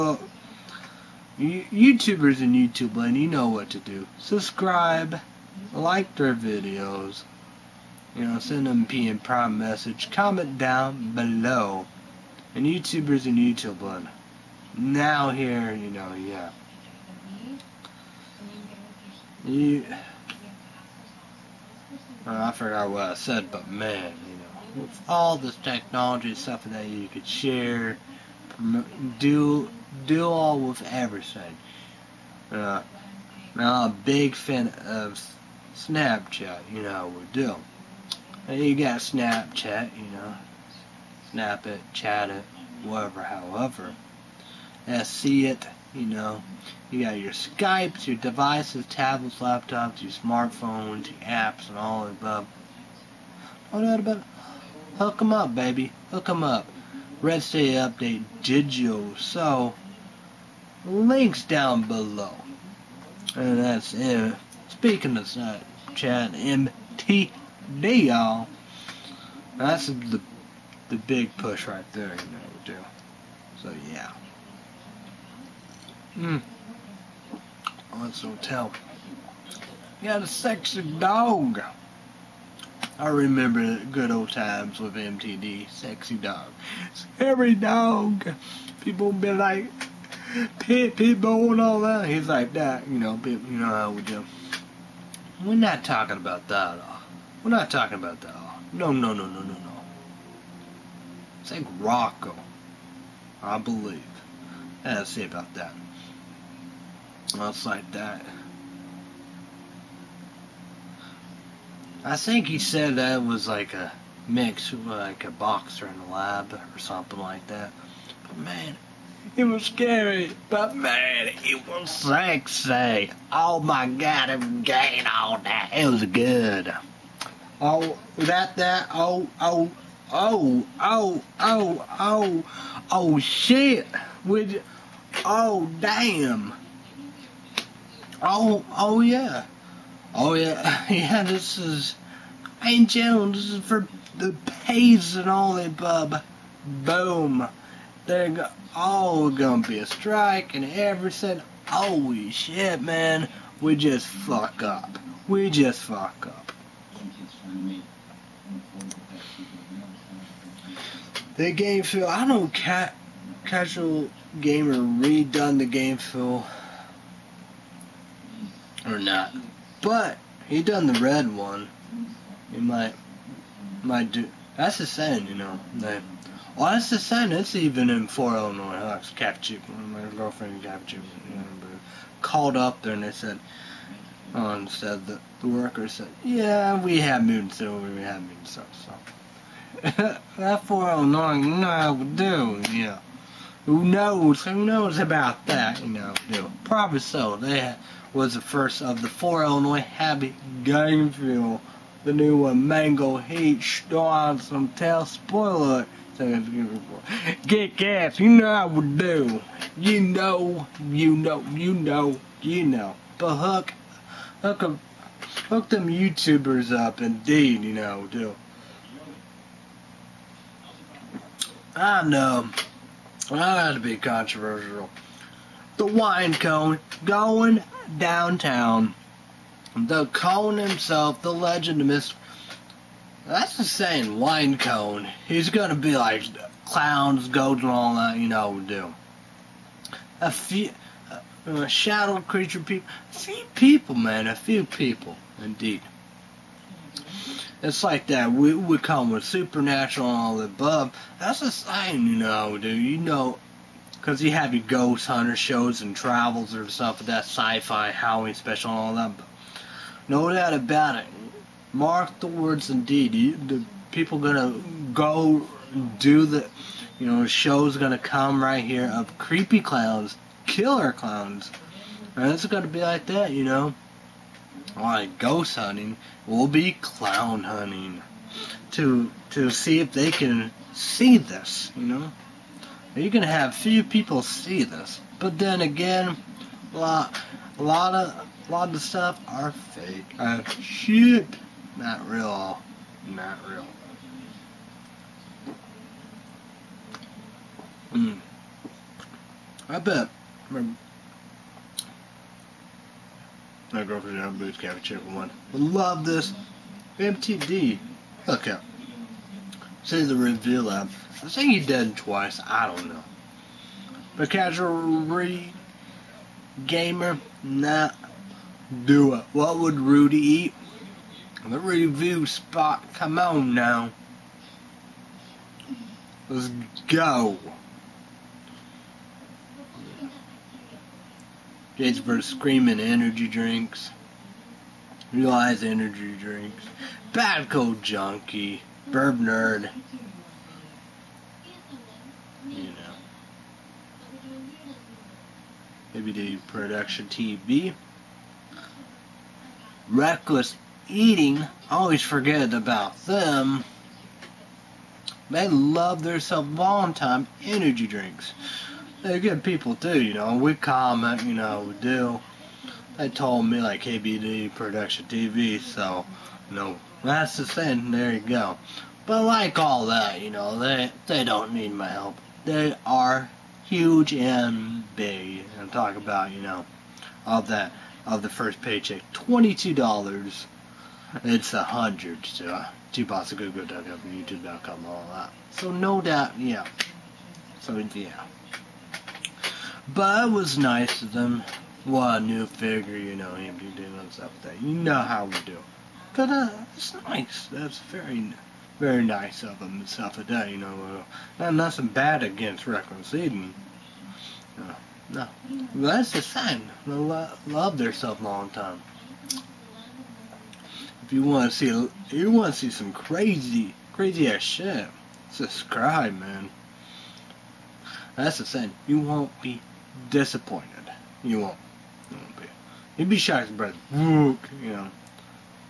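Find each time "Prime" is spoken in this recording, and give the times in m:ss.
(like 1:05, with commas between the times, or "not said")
0:09.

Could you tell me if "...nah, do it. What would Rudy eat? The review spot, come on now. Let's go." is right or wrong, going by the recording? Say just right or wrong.
right.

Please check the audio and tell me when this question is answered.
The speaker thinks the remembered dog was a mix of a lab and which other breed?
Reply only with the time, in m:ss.
1:55.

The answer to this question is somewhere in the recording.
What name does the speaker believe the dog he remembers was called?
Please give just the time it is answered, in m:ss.
1:41.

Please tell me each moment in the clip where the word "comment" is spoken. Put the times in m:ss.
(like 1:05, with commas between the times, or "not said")
0:10, 6:00.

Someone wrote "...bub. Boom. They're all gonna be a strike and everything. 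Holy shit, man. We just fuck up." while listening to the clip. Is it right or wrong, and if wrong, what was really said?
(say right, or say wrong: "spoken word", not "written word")
right.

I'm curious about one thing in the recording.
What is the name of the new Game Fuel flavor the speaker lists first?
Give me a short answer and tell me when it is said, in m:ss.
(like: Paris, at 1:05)
Mango Heat, at 3:22.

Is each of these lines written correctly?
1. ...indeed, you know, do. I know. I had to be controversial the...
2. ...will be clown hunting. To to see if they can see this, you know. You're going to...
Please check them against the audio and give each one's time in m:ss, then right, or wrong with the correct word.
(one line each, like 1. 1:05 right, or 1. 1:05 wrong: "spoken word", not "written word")
1. 3:37 right
2. 4:36 right.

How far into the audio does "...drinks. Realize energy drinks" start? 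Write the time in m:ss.
5:33.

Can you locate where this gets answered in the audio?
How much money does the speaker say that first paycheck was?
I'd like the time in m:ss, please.
6:19.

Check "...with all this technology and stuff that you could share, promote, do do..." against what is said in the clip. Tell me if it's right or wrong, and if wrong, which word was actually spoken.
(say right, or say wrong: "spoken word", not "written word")
right.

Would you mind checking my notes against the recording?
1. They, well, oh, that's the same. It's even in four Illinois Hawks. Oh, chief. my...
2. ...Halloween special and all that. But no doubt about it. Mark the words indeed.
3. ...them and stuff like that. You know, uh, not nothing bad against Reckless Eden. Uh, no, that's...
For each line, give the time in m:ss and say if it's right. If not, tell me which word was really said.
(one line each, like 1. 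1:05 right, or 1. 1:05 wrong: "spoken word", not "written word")
1. 2:55 right
2. 4:17 right
3. 6:39 right.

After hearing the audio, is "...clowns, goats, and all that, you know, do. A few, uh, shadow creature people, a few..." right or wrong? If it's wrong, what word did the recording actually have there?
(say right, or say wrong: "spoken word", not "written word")
right.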